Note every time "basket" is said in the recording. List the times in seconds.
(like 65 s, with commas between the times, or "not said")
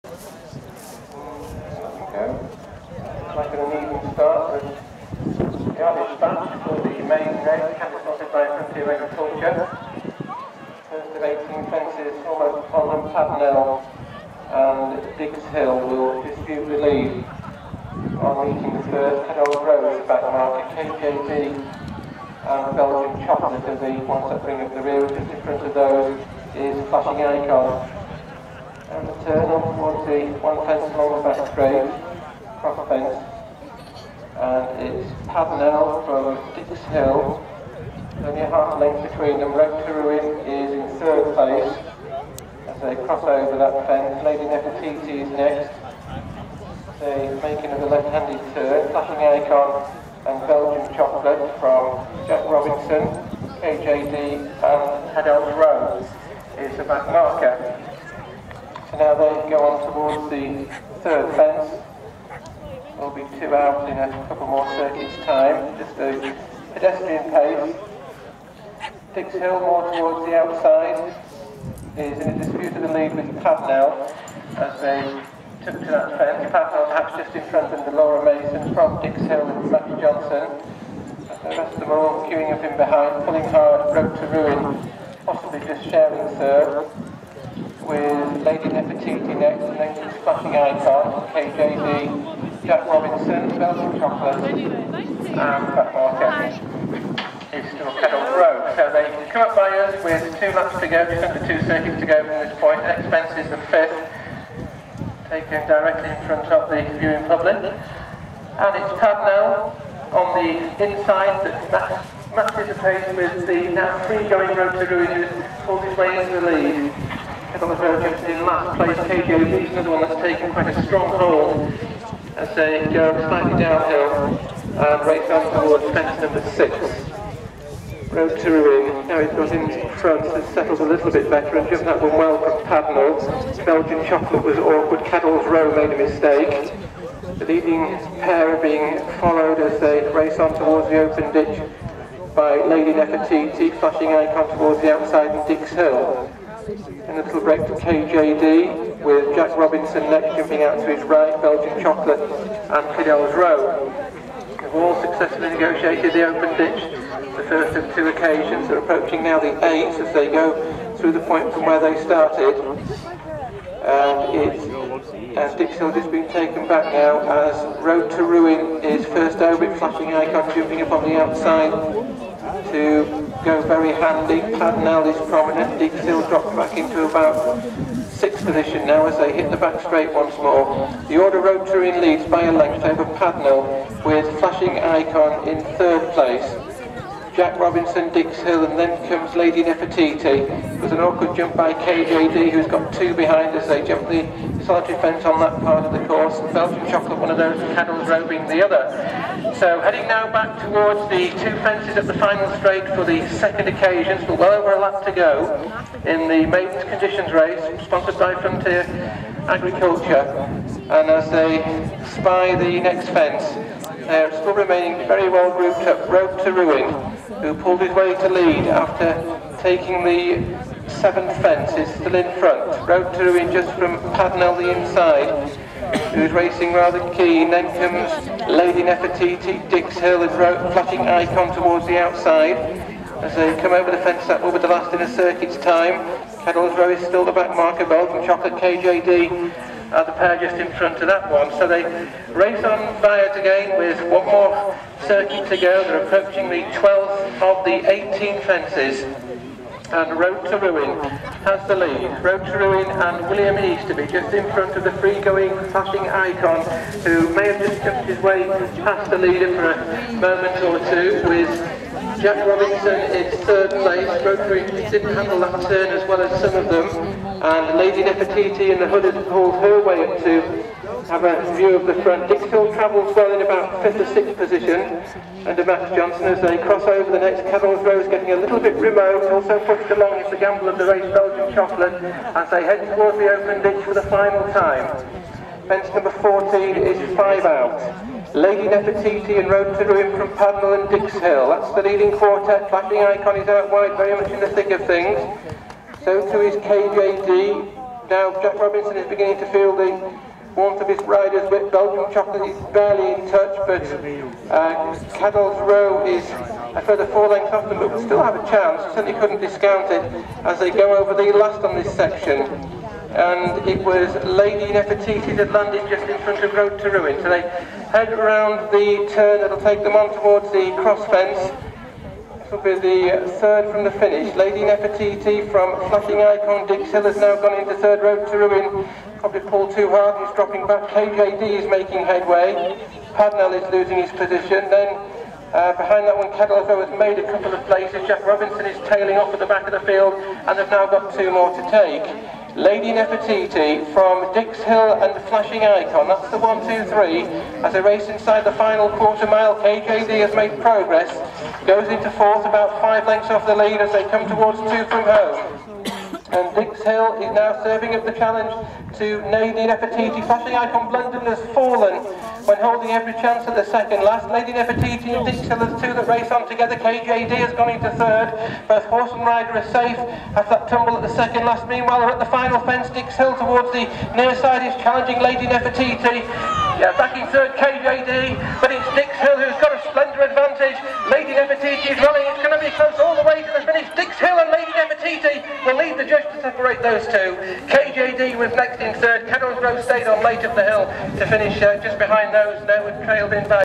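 not said.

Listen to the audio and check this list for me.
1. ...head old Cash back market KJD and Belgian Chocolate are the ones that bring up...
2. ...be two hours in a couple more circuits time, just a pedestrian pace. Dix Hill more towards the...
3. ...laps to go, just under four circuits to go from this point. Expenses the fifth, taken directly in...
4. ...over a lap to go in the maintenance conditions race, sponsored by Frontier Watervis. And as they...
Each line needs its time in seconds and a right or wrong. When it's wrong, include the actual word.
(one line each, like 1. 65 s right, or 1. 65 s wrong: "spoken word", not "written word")
1. 19 s wrong: "Rose", not "Cash"
2. 63 s right
3. 100 s wrong: "two", not "four"
4. 204 s wrong: "Agriculture", not "Watervis".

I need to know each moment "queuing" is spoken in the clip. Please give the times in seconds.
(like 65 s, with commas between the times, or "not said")
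82 s.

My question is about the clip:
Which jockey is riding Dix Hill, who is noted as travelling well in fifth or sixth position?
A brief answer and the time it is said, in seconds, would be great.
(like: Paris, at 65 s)
Max Johnson, at 275 s.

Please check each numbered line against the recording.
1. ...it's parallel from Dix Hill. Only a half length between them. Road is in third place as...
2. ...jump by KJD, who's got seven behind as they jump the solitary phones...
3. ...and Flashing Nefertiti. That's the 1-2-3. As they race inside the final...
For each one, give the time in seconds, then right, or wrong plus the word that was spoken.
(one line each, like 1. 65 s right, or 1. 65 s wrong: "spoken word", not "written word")
1. 34 s right
2. 191 s wrong: "two", not "seven"
3. 345 s wrong: "Icon", not "Nefertiti".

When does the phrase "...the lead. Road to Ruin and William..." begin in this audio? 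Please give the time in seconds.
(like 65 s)
251 s.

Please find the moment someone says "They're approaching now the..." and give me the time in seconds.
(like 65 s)
158 s.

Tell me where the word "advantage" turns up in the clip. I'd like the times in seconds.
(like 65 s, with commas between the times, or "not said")
380 s.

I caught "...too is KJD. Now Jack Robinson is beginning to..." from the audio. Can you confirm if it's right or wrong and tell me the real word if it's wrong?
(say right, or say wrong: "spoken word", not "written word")
right.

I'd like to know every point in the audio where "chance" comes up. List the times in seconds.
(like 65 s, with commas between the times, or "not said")
308 s, 363 s.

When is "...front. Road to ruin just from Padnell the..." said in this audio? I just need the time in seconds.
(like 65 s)
222 s.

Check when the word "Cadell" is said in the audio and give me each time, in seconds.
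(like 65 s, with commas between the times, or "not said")
152 s, 305 s.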